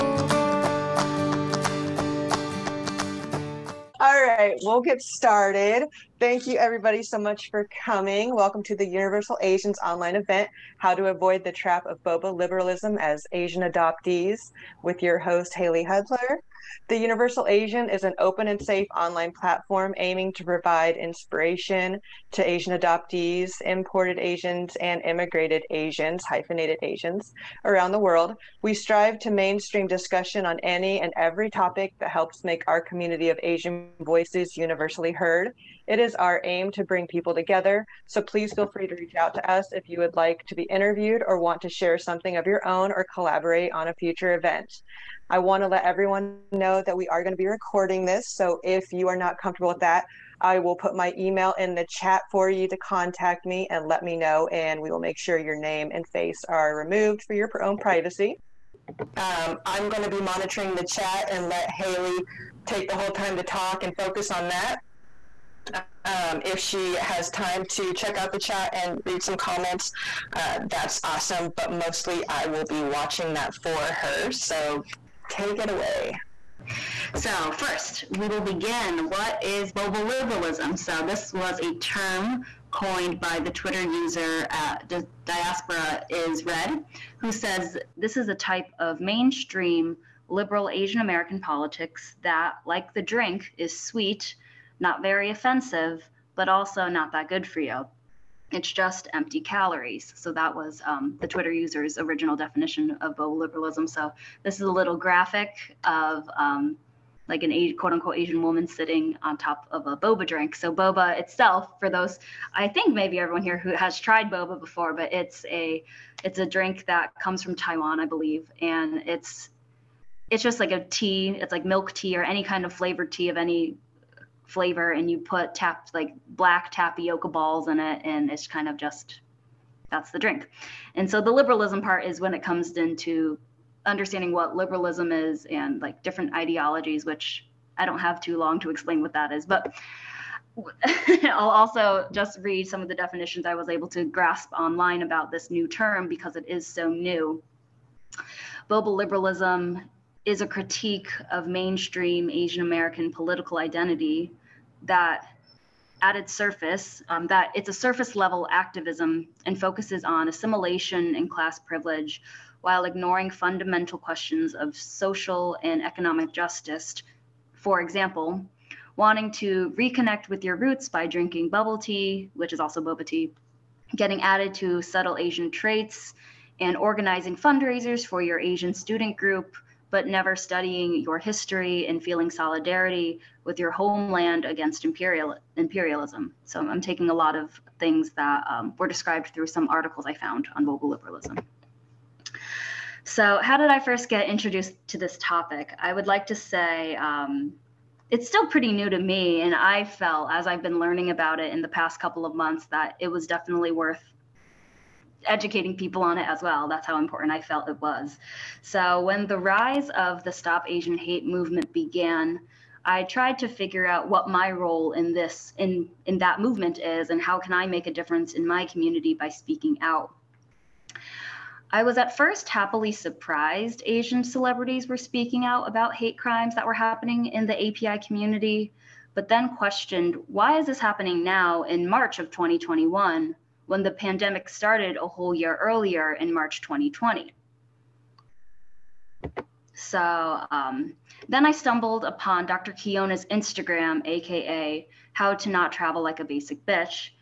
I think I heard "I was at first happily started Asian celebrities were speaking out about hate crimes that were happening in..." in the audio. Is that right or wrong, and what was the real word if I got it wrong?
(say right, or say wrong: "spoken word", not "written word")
wrong: "surprised", not "started".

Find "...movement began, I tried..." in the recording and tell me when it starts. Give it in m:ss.
3:31.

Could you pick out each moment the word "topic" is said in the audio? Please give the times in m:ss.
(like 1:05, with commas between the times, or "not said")
0:31, 3:15.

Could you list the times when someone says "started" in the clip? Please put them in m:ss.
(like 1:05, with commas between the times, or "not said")
0:05, 3:54.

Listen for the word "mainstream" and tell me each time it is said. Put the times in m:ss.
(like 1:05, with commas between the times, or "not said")
0:29, 1:28, 2:31.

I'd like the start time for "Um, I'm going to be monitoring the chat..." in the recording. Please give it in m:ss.
0:59.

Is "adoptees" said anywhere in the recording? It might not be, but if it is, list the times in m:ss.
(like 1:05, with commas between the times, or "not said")
0:13, 0:22.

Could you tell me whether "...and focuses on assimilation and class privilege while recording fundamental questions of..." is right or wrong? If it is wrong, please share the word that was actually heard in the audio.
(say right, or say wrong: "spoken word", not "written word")
wrong: "ignoring", not "recording".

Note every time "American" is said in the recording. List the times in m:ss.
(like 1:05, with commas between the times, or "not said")
1:30, 2:32.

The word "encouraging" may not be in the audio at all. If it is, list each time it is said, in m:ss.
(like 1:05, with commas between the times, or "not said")
not said.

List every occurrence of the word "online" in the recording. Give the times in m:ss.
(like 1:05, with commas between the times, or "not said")
0:09, 0:18, 2:24.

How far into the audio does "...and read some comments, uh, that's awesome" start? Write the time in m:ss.
1:08.